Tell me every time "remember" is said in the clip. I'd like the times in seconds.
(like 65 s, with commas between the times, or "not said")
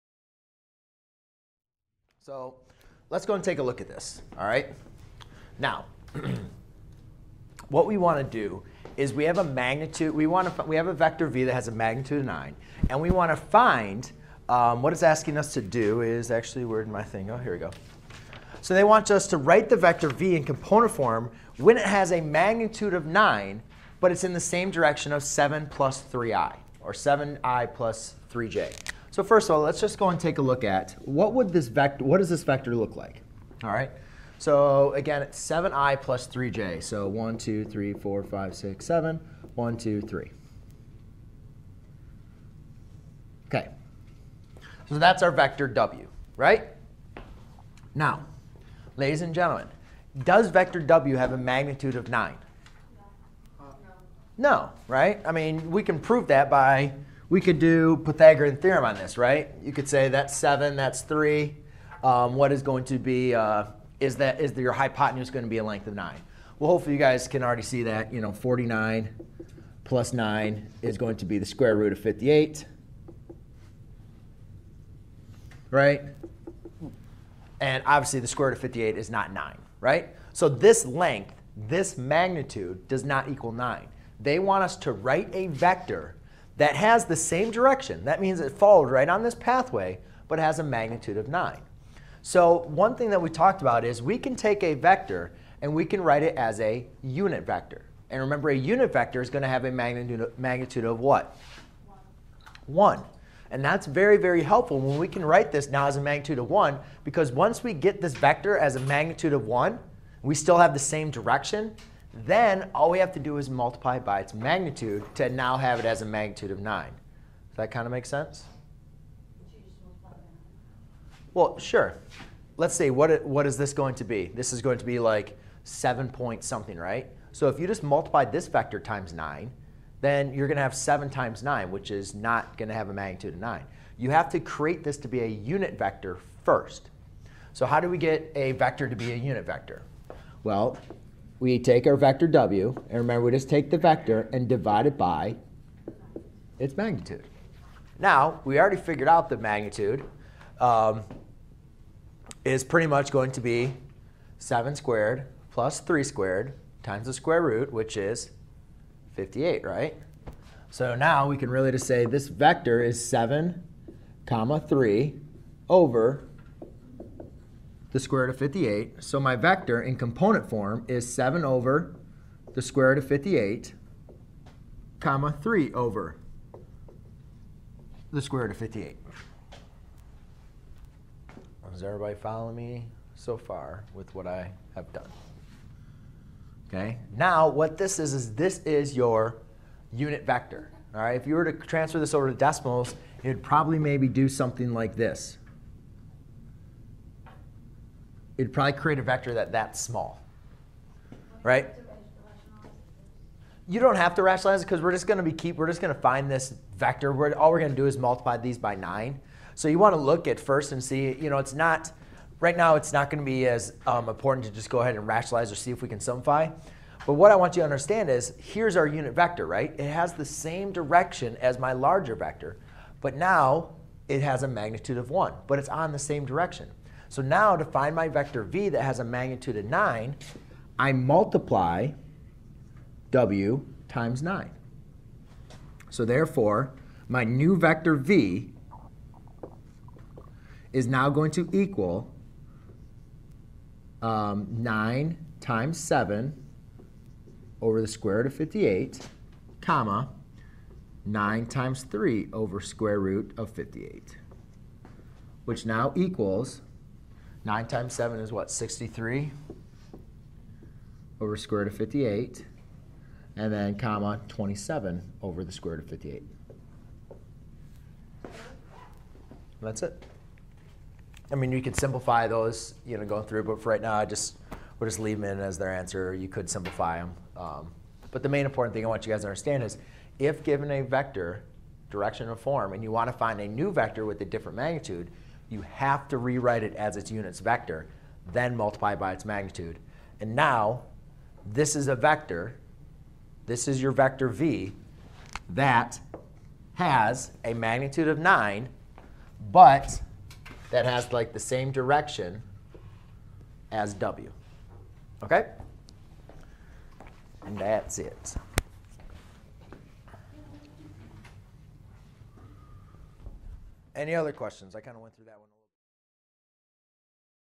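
98 s, 142 s.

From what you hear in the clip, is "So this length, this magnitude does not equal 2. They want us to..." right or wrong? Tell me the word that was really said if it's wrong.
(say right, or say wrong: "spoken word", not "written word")
wrong: "9", not "2".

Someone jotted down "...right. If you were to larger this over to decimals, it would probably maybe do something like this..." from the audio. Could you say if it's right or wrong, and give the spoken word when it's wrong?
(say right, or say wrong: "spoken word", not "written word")
wrong: "transfer", not "larger".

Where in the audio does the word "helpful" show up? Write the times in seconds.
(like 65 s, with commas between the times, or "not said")
104 s.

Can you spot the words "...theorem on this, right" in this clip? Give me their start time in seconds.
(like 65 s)
58 s.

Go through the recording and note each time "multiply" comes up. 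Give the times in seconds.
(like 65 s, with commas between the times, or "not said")
113 s, 127 s, 207 s, 230 s, 288 s.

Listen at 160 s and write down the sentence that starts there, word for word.
So now we can really just say this vector is 7 comma 3 over the square root of 58.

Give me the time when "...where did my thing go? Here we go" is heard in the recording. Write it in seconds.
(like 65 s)
16 s.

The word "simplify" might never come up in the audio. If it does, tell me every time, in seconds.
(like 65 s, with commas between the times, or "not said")
215 s, 271 s, 276 s.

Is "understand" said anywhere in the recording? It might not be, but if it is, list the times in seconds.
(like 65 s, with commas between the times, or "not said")
217 s, 279 s.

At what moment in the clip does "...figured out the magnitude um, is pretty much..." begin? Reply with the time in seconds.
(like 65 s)
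148 s.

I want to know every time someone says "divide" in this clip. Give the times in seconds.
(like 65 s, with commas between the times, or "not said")
144 s.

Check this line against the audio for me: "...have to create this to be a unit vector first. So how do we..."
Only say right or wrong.
right.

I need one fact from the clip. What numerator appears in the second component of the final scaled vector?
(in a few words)
27.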